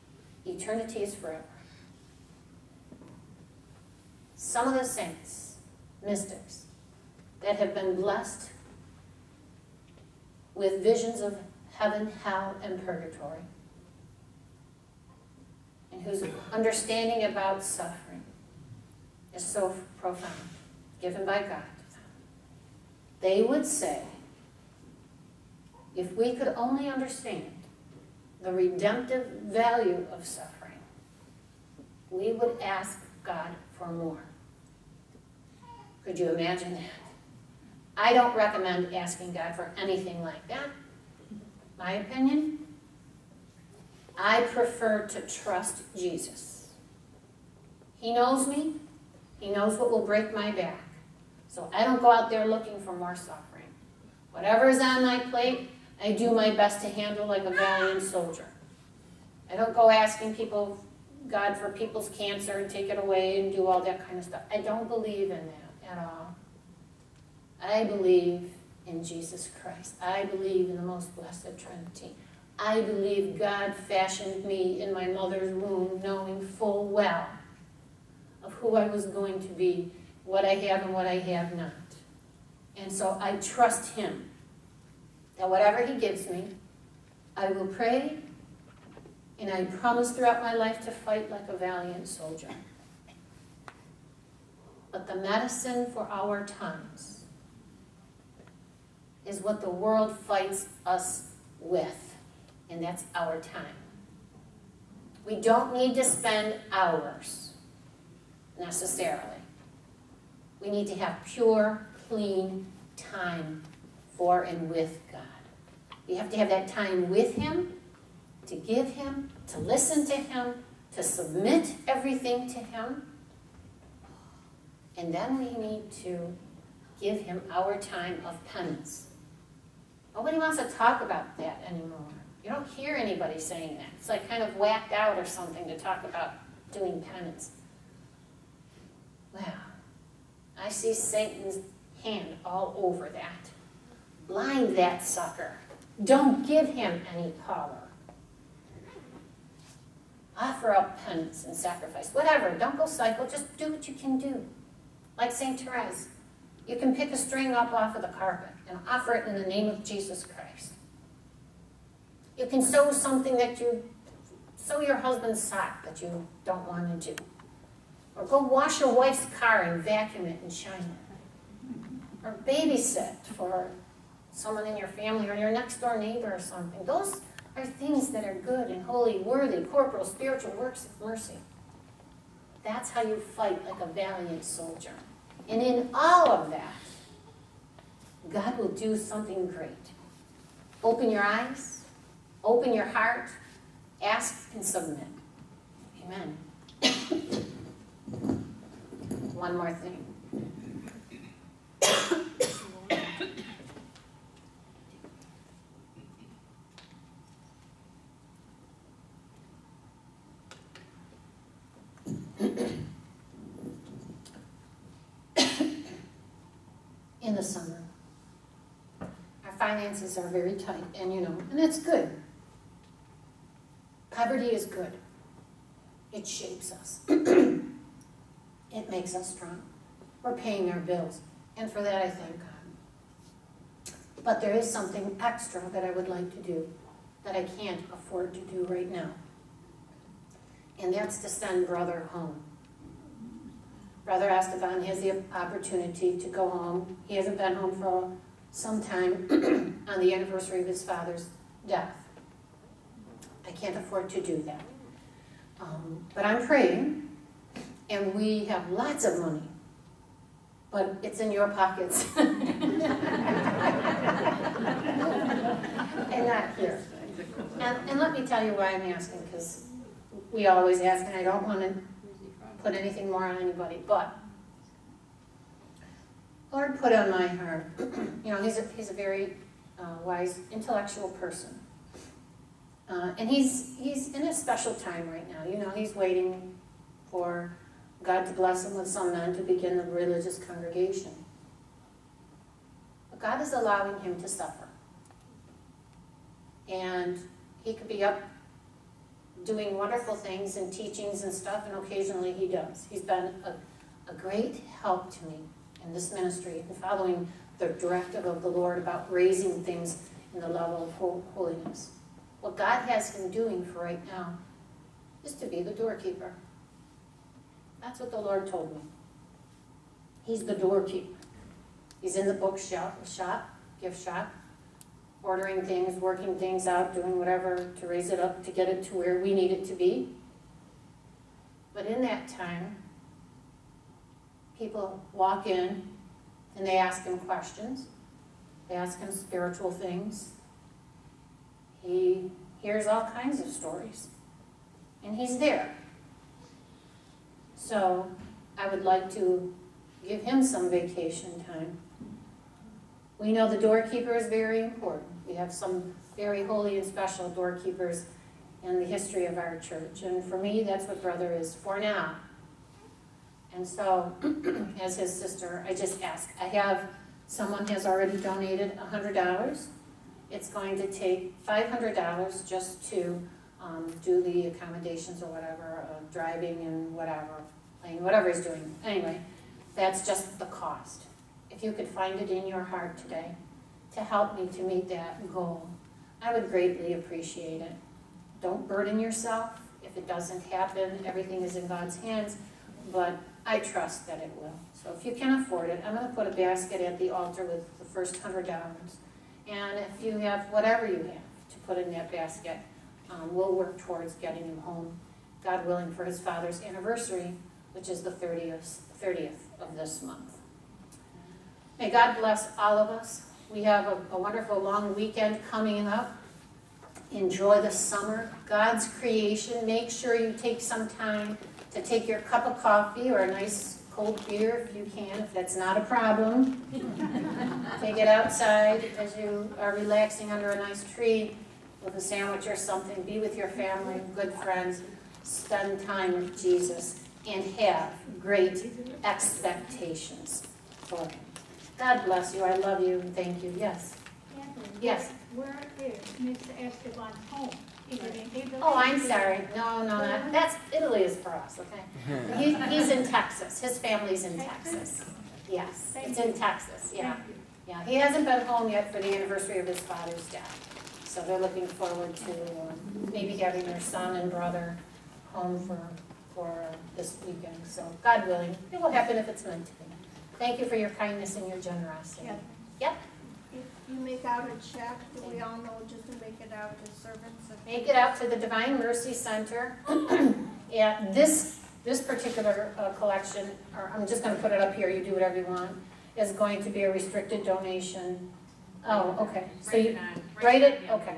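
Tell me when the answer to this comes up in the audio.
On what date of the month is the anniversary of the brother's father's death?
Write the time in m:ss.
6:49.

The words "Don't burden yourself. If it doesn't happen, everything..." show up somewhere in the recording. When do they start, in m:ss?
6:28.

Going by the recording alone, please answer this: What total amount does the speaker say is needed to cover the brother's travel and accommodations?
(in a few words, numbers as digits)
$500.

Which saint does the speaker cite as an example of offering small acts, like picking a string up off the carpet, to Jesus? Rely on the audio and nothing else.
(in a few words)
St. Therese.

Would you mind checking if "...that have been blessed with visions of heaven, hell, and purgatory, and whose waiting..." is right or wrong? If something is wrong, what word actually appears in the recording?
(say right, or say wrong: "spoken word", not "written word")
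wrong: "understanding", not "waiting".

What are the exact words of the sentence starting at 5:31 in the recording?
But in that time, people walk in and they ask him questions.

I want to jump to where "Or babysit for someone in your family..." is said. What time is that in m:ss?
2:52.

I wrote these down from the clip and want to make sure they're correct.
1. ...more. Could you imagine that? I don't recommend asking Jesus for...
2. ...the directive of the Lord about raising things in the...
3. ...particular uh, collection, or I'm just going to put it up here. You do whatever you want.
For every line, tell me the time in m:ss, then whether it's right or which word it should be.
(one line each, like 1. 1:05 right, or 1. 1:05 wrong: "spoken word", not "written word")
1. 0:33 wrong: "God", not "Jesus"
2. 5:07 right
3. 8:02 right.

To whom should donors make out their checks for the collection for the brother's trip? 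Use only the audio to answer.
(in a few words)
Divine Mercy Center.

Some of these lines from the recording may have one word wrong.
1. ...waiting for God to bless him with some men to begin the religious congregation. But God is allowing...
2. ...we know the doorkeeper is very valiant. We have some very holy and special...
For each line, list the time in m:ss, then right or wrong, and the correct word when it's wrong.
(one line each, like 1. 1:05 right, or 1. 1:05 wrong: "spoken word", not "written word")
1. 4:45 right
2. 5:53 wrong: "important", not "valiant".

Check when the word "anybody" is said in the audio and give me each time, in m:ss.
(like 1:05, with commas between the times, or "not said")
2:12, 4:33.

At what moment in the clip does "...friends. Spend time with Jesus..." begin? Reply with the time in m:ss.
7:14.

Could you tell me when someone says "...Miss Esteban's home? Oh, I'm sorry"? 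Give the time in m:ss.
7:26.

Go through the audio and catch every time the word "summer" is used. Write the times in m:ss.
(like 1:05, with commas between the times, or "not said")
3:37, 6:57.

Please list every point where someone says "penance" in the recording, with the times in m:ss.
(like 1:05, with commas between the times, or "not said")
2:08, 2:17, 2:31.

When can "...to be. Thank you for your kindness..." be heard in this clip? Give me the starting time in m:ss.
7:49.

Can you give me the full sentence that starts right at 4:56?
And he could be up doing wonderful things and teachings and stuff, and occasionally he does.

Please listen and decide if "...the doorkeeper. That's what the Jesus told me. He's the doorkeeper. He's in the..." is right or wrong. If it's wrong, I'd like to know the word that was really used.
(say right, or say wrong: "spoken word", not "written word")
wrong: "Lord", not "Jesus".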